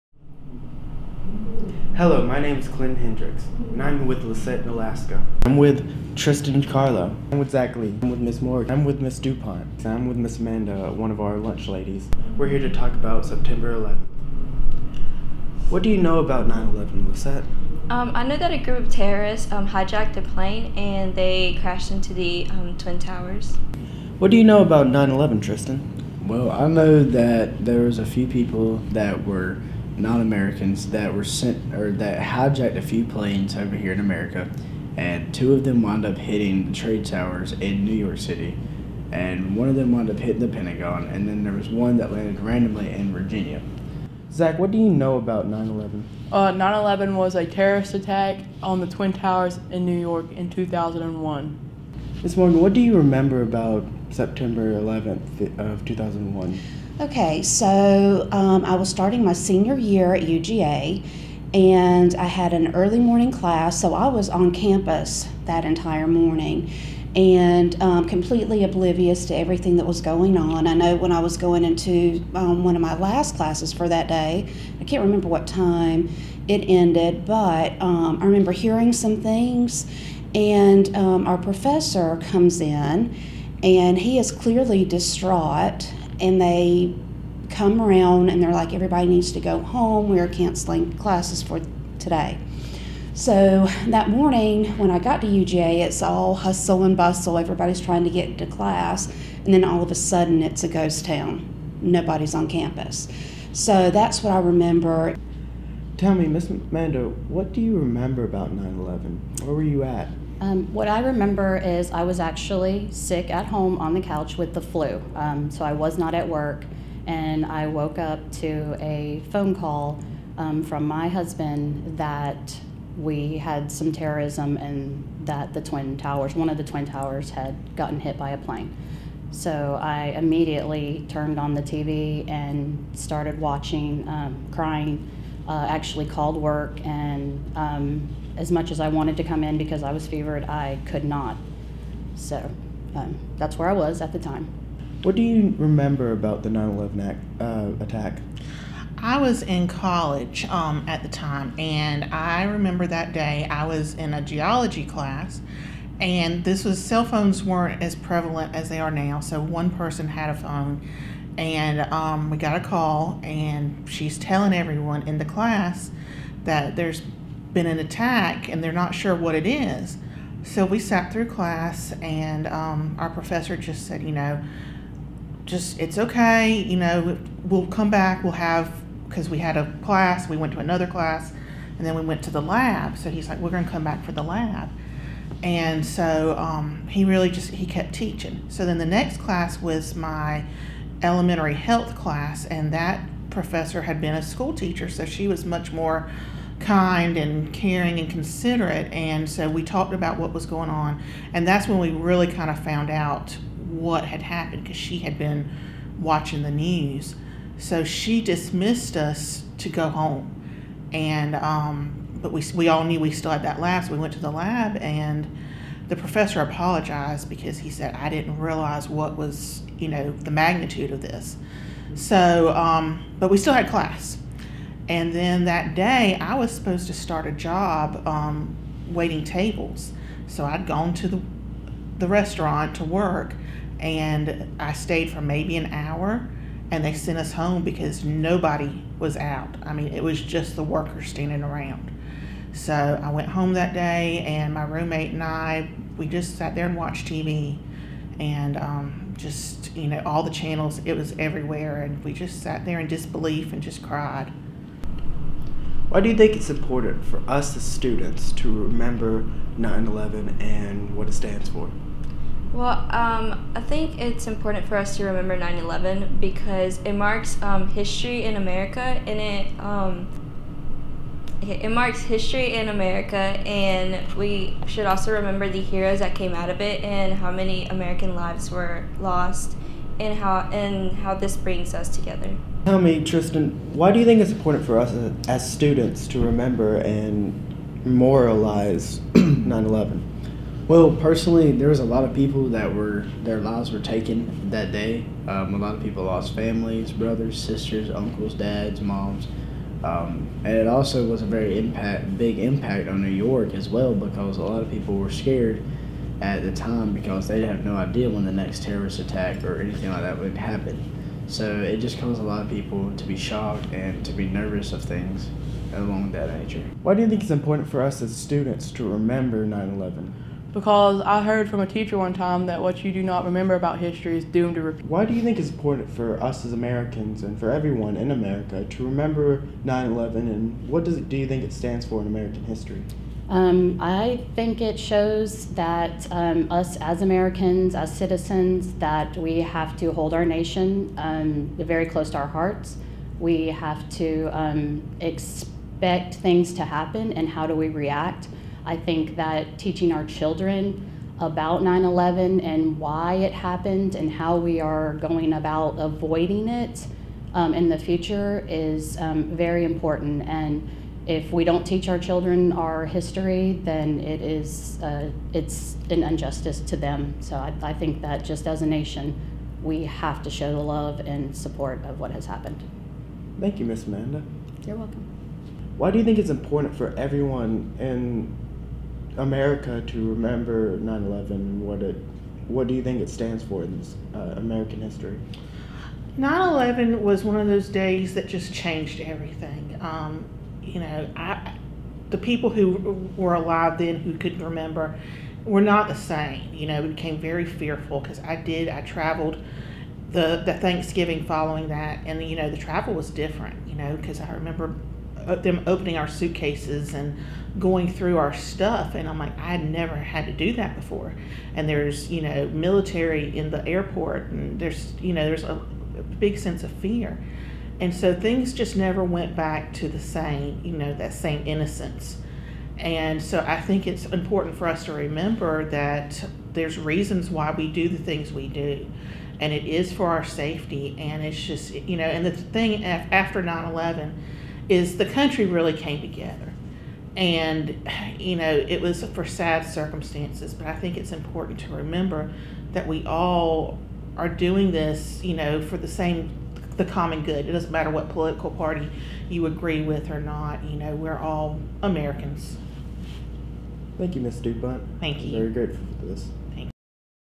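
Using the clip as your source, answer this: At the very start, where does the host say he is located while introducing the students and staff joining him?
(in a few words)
Alaska.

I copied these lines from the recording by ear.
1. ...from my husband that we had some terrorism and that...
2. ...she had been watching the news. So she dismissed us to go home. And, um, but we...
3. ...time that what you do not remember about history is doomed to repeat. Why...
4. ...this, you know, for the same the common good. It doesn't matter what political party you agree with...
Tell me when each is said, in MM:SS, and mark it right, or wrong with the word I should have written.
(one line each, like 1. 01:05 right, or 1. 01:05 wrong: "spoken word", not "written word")
1. 02:00 right
2. 03:24 right
3. 05:22 right
4. 07:24 right.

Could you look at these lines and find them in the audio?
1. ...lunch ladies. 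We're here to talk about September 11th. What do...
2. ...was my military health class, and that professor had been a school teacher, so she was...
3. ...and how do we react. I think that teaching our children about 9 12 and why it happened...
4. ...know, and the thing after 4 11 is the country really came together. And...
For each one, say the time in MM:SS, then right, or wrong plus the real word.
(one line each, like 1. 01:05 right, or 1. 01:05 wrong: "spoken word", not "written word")
1. 00:11 right
2. 03:09 wrong: "elementary", not "military"
3. 05:47 wrong: "11", not "12"
4. 07:11 wrong: "9", not "4".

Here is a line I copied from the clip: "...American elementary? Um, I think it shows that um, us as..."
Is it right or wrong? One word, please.
wrong.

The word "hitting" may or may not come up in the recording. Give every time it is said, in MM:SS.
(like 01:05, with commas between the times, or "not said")
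00:36, 00:40.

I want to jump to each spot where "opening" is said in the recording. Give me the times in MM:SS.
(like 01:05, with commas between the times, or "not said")
06:45.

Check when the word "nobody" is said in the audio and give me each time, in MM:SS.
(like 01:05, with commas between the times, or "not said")
01:41, 03:58.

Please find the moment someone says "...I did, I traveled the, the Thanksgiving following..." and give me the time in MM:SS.
06:38.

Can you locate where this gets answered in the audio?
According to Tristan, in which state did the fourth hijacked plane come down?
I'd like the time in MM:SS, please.
00:43.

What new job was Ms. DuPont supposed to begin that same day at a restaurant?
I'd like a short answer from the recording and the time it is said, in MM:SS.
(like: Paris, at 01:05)
Waiting tables, at 03:48.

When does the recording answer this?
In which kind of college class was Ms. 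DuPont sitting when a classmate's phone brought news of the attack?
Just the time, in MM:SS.
02:34.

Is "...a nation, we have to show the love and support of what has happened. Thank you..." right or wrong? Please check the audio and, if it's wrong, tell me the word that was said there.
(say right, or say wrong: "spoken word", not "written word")
right.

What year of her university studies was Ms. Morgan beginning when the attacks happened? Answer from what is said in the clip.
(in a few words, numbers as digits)
Senior year.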